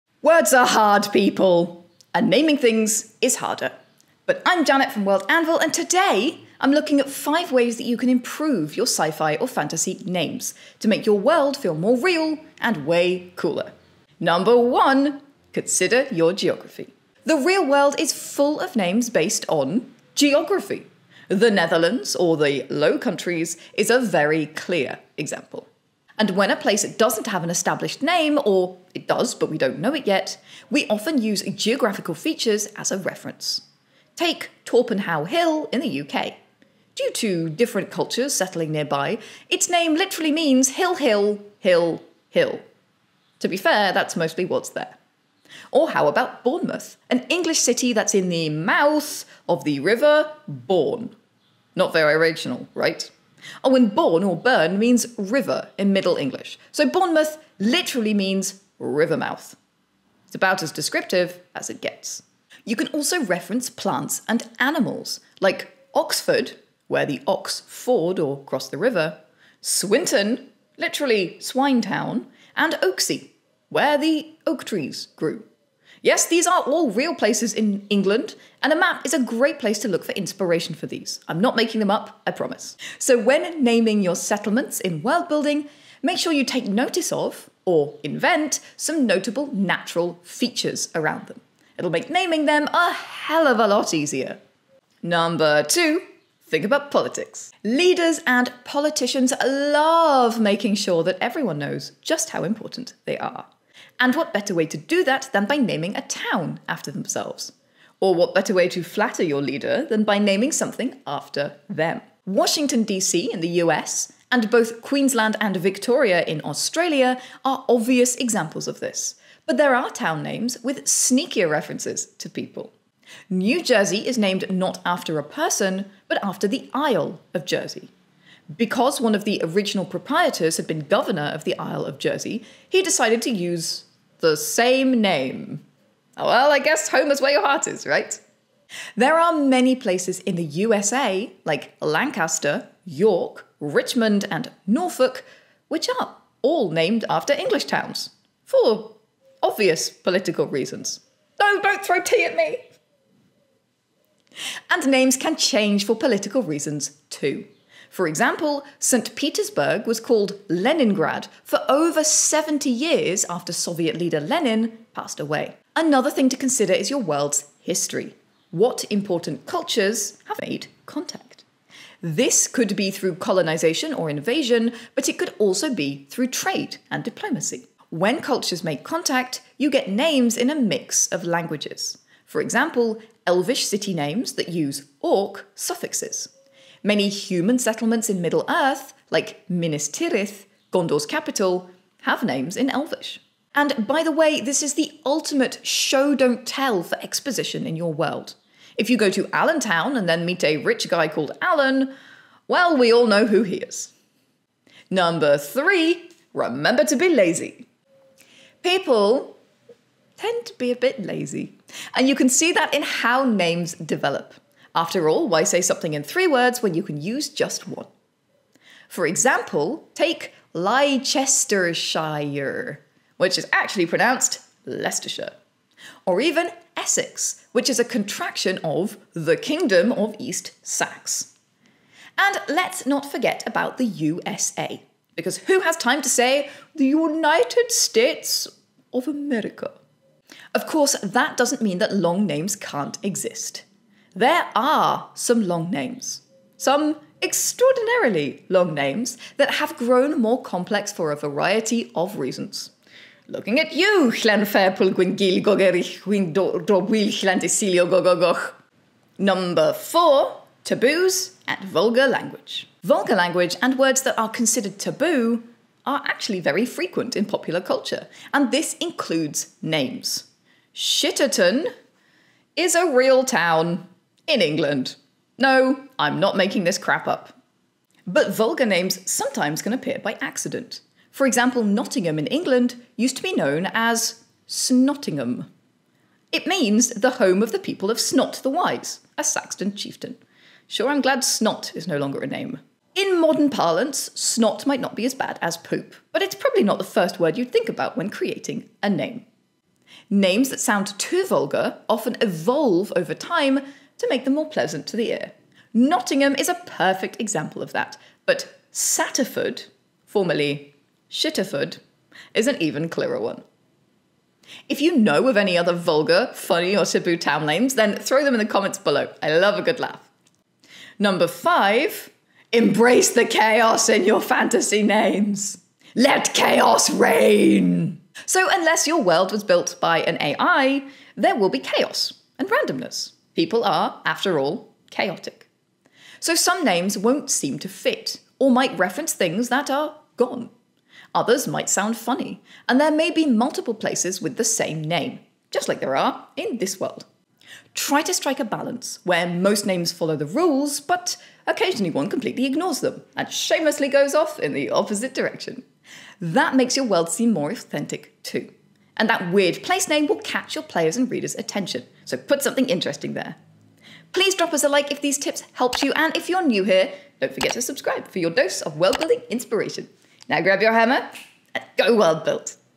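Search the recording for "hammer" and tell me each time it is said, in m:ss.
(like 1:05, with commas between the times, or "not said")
6:10.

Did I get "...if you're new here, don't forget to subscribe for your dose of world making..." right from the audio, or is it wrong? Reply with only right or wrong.
wrong.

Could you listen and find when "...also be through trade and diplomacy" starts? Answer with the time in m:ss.
2:55.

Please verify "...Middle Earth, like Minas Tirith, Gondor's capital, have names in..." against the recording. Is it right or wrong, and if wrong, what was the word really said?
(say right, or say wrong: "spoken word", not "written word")
right.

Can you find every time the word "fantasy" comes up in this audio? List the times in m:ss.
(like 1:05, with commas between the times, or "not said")
0:09, 5:24.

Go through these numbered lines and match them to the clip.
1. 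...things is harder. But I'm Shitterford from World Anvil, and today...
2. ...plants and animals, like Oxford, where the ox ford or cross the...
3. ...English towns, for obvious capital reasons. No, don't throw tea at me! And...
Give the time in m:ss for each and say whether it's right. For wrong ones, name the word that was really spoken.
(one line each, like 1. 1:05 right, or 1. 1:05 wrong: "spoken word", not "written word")
1. 0:02 wrong: "Janet", not "Shitterford"
2. 1:03 right
3. 2:27 wrong: "political", not "capital".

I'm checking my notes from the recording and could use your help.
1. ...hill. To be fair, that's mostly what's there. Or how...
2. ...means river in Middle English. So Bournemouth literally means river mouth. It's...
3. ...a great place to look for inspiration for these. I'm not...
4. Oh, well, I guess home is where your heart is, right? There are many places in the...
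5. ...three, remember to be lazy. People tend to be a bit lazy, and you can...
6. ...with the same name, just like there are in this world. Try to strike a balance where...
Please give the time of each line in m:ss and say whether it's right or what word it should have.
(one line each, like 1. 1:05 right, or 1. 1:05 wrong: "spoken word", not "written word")
1. 0:42 right
2. 0:54 right
3. 1:19 right
4. 2:16 right
5. 3:25 right
6. 5:44 right.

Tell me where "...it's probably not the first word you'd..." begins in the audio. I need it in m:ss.
4:56.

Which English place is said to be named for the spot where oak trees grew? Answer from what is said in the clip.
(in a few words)
Oaksey.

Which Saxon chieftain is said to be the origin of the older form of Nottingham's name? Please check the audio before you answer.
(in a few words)
Snot the Wise.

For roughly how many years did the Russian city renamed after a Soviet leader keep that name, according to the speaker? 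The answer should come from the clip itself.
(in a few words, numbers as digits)
over 70 years.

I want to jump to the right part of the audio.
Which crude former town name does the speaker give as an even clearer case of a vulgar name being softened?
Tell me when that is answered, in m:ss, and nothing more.
5:11.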